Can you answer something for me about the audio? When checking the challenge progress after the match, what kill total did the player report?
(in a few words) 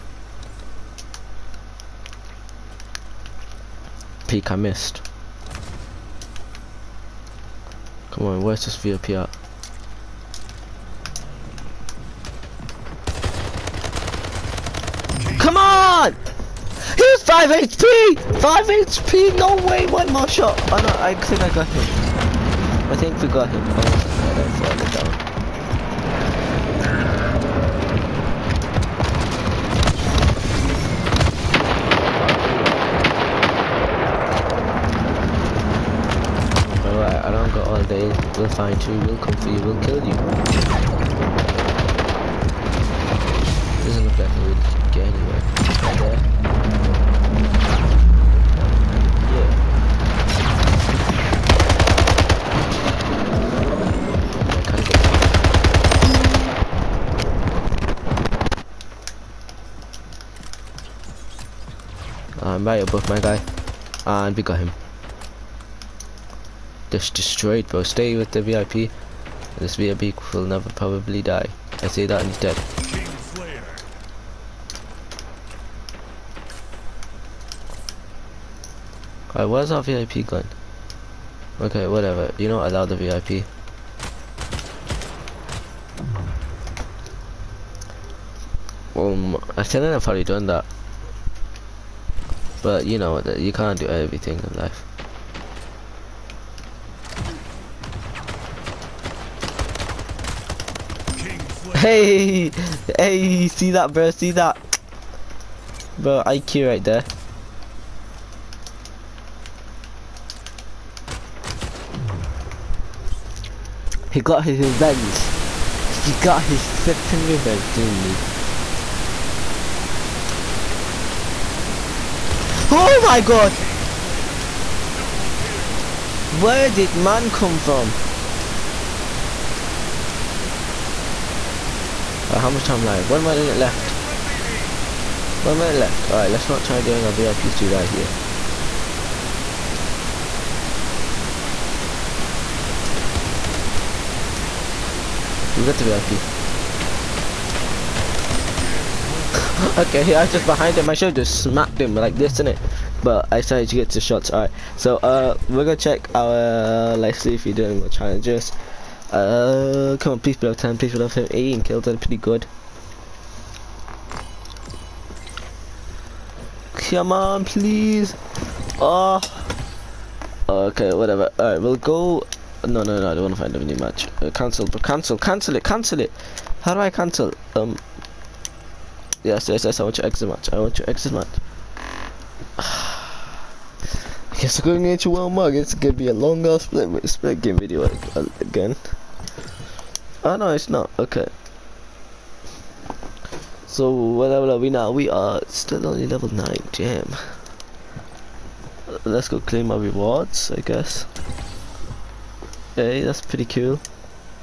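18.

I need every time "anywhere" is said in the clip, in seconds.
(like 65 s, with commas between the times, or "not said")
45 s.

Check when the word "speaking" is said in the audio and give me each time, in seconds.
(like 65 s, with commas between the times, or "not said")
not said.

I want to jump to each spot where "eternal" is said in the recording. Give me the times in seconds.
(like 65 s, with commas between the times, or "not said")
not said.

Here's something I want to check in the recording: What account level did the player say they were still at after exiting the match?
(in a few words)
9.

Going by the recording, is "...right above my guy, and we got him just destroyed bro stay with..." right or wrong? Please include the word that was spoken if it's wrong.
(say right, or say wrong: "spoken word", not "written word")
right.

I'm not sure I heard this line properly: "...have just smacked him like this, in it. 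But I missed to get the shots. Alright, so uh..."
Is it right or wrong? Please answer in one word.
wrong.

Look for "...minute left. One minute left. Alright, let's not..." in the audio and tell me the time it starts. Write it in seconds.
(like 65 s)
133 s.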